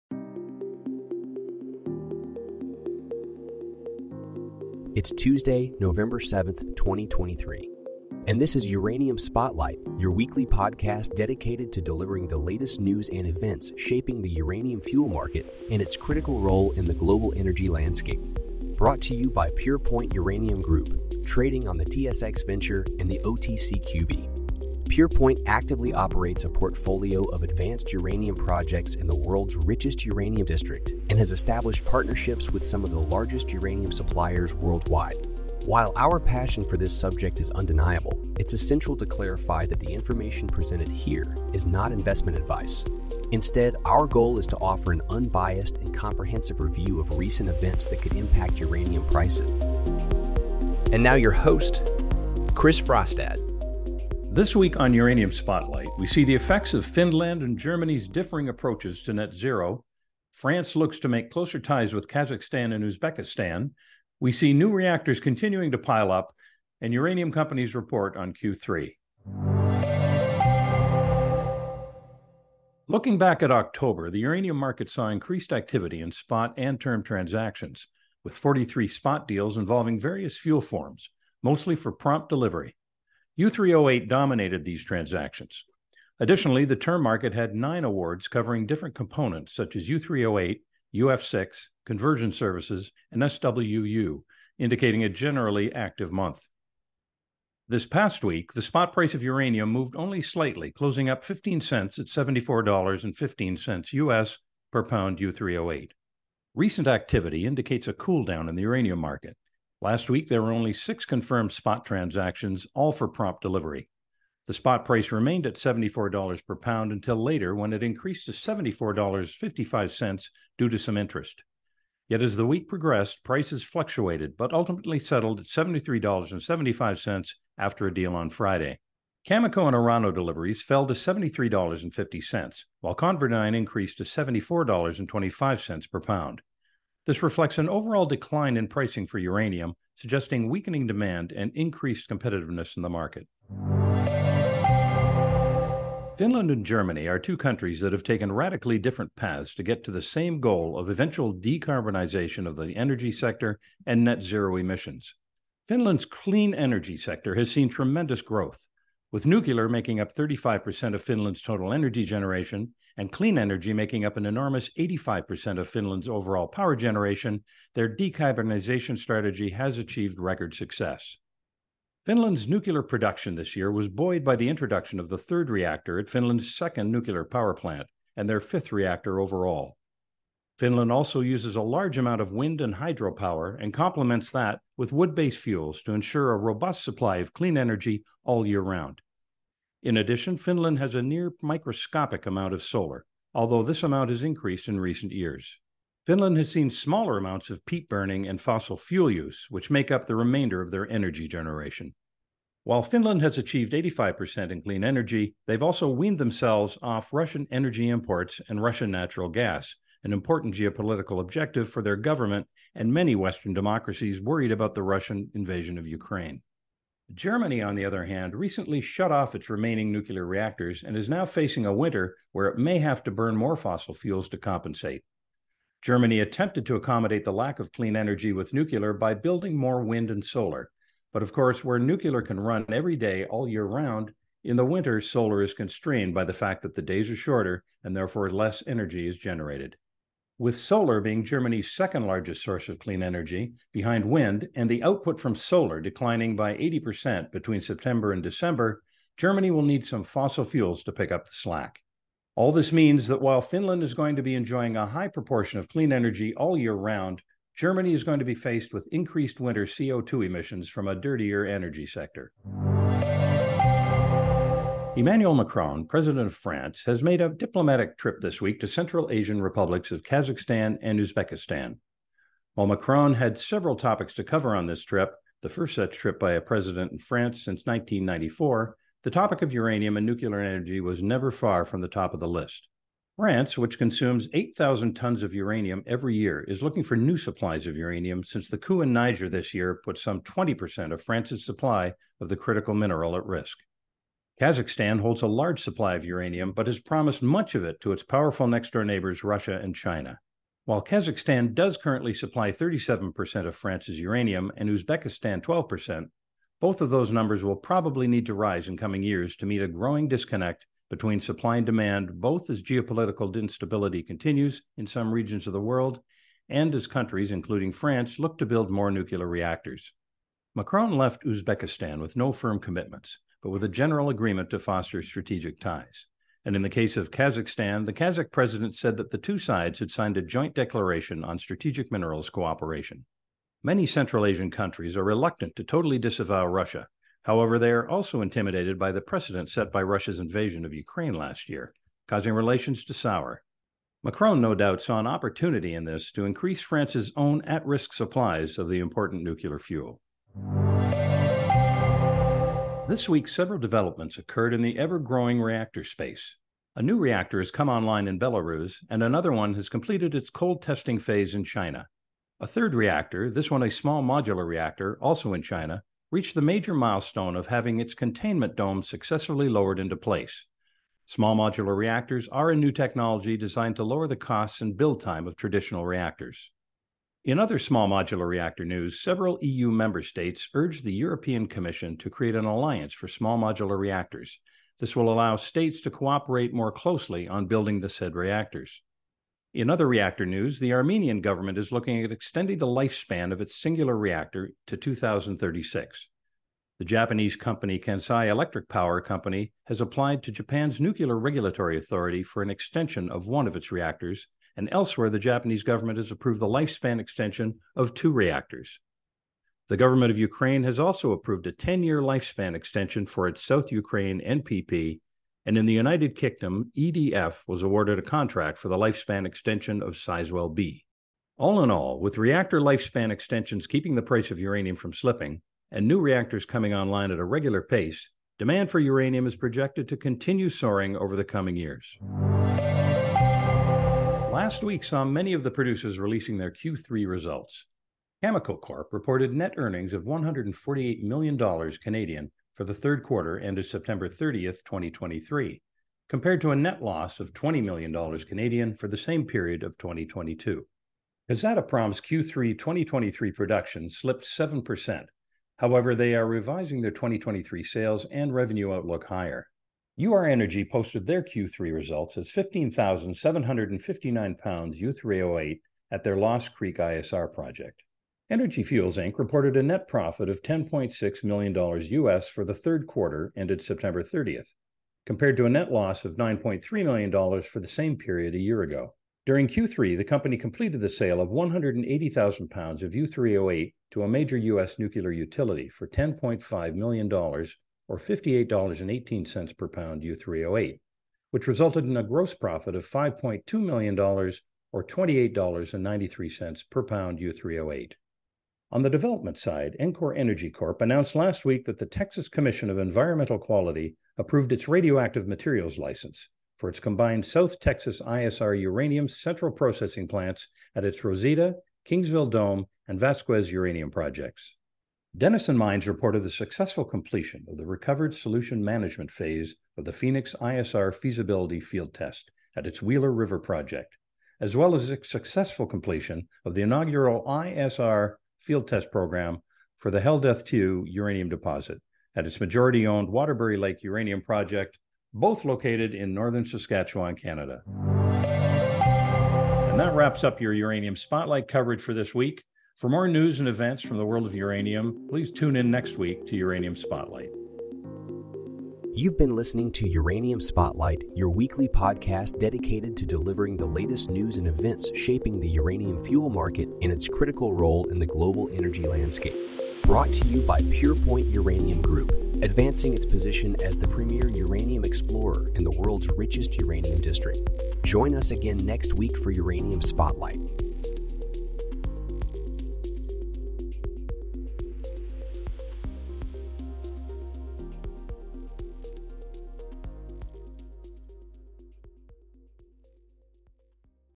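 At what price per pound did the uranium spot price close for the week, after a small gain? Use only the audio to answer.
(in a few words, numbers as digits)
$74.15.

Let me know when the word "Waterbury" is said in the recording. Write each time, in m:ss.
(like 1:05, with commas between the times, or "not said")
8:53.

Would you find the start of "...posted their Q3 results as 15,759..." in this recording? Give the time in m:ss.
7:40.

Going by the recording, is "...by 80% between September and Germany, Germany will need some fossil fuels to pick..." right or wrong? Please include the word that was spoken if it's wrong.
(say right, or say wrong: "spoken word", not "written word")
wrong: "December", not "Germany".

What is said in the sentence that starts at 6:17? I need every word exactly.
In other small modular reactor news, several EU member states urged the European Commission to create an alliance for small modular reactors.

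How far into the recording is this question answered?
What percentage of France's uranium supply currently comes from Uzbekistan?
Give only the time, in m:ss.
5:04.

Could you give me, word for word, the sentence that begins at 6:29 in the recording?
In other reactor news, the Armenian government is looking at extending the lifespan of its singular reactor to 2036.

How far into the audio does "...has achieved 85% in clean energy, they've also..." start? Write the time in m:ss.
3:23.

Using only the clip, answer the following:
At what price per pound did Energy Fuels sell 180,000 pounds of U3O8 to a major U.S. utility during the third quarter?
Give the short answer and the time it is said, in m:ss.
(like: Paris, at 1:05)
$58.18, at 8:07.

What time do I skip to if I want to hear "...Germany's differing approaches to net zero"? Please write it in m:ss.
0:57.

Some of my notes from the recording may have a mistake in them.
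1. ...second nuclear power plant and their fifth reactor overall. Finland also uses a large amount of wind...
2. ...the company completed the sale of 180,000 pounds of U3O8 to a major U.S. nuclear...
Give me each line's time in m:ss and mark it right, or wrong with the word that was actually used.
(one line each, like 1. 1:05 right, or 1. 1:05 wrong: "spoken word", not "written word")
1. 2:56 right
2. 7:59 right.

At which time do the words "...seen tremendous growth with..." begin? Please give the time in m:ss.
2:37.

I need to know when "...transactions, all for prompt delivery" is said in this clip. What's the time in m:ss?
1:51.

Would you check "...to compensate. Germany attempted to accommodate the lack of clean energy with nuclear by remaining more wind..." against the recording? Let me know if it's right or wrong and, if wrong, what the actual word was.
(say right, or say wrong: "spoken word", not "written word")
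wrong: "building", not "remaining".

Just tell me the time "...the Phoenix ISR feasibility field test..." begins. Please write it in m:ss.
8:39.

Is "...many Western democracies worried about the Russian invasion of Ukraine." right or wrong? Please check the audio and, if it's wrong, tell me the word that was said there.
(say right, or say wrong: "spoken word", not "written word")
right.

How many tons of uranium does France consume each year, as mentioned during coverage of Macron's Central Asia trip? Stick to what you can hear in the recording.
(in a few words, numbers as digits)
8,000 tons.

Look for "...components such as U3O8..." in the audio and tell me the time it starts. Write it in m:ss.
1:28.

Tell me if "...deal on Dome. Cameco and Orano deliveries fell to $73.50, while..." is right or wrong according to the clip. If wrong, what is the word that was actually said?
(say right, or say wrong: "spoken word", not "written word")
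wrong: "Friday", not "Dome".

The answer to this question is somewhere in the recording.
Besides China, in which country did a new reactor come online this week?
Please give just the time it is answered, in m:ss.
5:58.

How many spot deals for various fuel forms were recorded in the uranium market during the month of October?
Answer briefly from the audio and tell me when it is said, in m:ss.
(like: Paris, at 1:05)
43, at 1:18.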